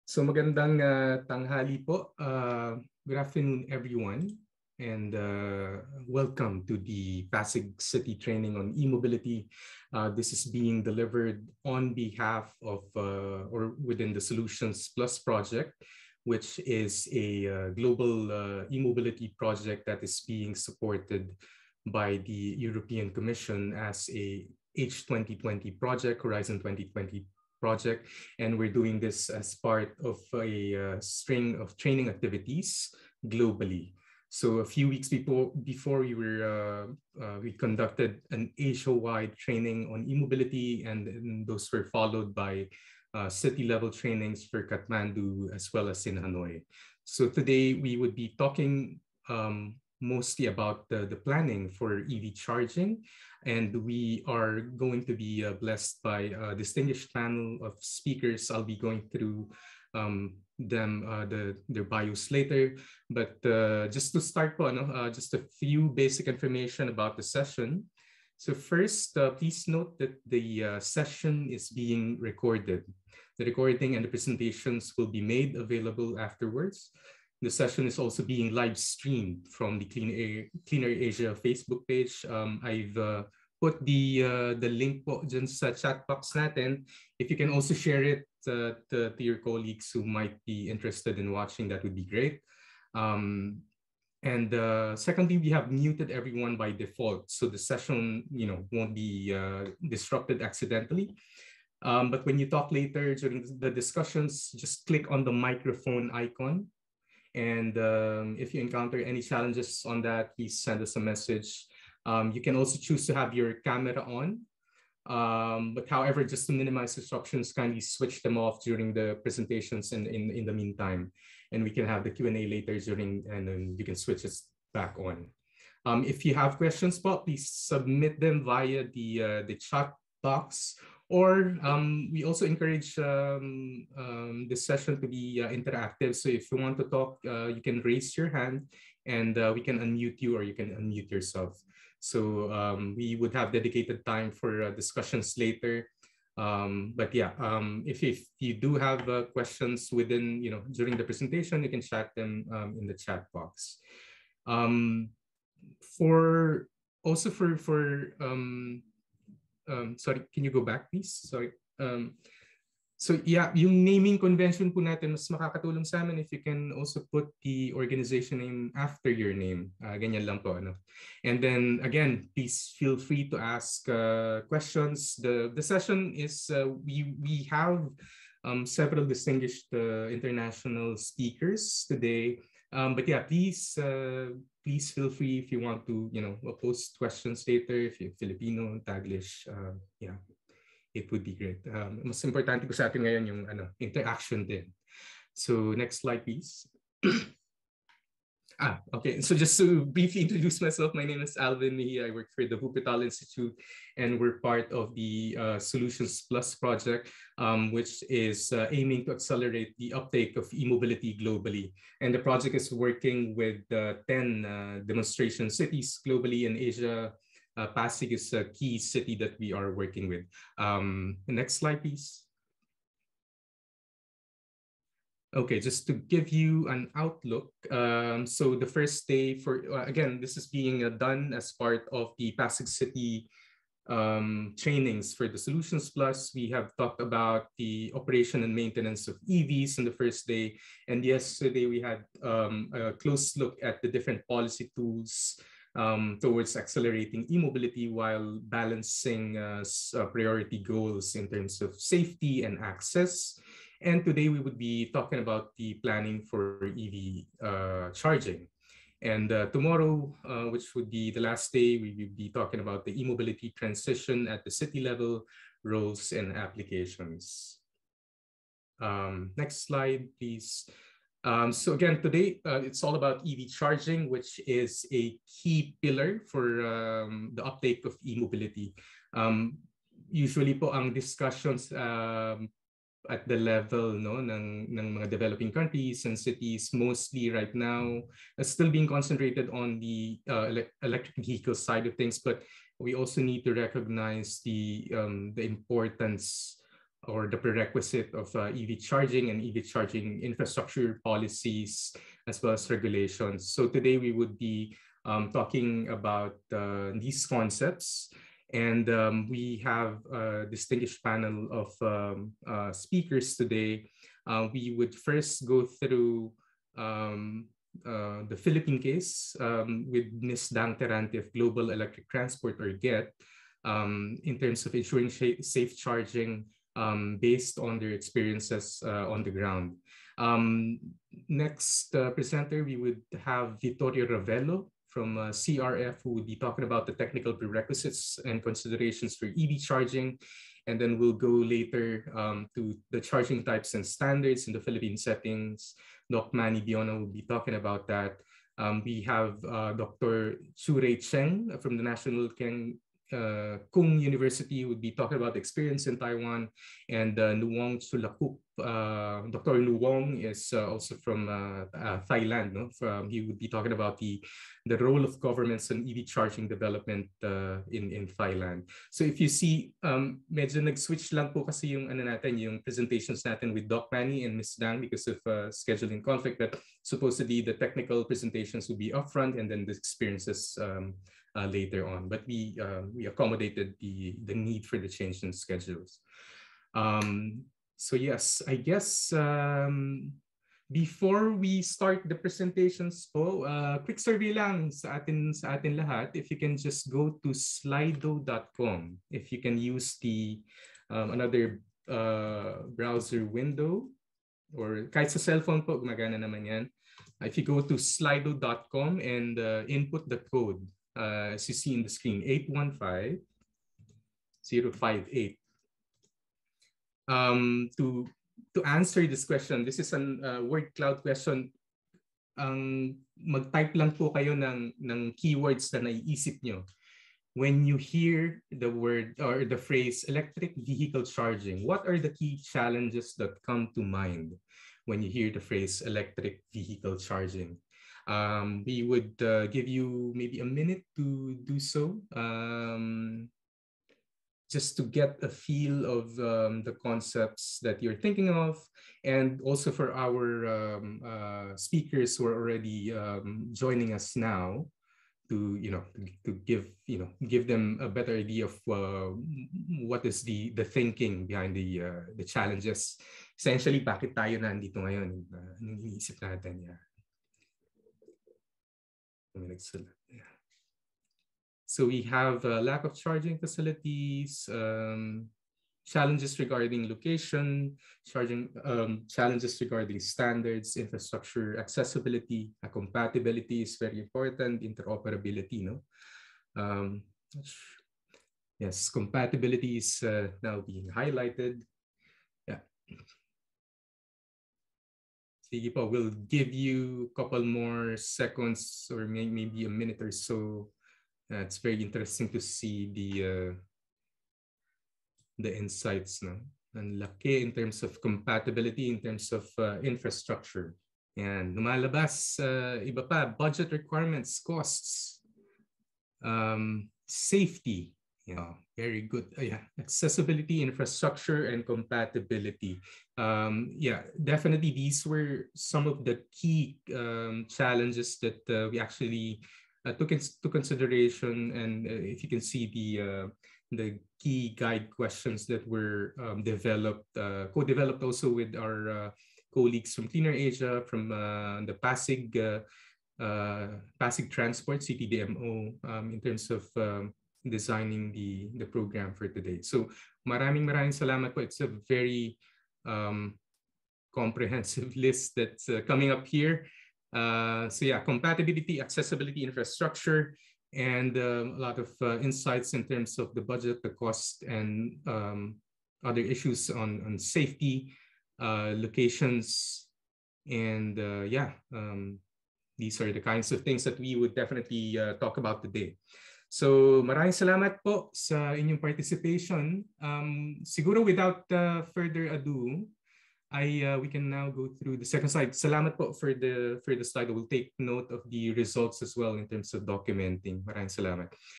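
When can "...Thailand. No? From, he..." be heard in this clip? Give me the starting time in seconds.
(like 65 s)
362 s.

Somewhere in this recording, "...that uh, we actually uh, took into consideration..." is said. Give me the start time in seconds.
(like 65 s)
528 s.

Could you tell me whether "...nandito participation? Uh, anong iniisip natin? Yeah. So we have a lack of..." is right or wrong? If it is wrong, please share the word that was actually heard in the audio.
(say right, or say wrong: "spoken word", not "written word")
wrong: "ngayon", not "participation".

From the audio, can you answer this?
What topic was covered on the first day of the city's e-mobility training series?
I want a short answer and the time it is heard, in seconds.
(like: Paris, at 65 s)
Operation and maintenance of EVs, at 237 s.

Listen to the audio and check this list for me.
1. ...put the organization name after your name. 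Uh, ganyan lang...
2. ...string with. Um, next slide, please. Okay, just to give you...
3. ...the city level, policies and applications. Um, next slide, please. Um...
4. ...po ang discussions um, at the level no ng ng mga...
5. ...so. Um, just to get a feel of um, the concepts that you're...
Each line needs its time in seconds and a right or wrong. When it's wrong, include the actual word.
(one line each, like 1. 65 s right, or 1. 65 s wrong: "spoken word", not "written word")
1. 167 s right
2. 219 s wrong: "working", not "string"
3. 264 s wrong: "roles", not "policies"
4. 280 s right
5. 441 s right.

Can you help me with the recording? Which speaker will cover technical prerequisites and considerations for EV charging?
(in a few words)
Vittorio Ravello.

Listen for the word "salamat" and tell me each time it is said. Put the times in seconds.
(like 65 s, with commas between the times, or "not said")
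550 s, 577 s, 585 s, 590 s.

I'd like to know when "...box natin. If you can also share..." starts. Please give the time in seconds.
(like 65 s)
86 s.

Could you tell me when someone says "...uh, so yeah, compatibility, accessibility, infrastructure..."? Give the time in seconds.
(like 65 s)
557 s.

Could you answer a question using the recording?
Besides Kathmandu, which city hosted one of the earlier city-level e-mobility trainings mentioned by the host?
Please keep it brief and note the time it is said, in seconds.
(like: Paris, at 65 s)
Hanoi, at 46 s.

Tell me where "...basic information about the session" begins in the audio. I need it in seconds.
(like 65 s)
65 s.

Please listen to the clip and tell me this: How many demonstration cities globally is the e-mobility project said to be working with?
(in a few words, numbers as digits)
10.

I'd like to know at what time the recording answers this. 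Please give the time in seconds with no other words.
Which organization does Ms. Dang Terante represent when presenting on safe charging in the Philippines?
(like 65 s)
321 s.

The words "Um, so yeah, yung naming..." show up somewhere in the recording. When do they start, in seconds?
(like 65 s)
161 s.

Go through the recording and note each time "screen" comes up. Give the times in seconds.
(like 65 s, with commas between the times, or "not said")
411 s.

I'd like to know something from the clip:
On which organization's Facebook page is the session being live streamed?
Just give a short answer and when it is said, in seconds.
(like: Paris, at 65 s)
Clean Air, Cleaner Asia, at 79 s.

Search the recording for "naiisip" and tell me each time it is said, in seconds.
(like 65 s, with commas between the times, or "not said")
425 s.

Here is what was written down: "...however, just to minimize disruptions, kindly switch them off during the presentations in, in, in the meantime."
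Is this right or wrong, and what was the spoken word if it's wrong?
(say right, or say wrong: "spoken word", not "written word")
right.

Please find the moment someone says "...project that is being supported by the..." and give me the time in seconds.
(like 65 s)
19 s.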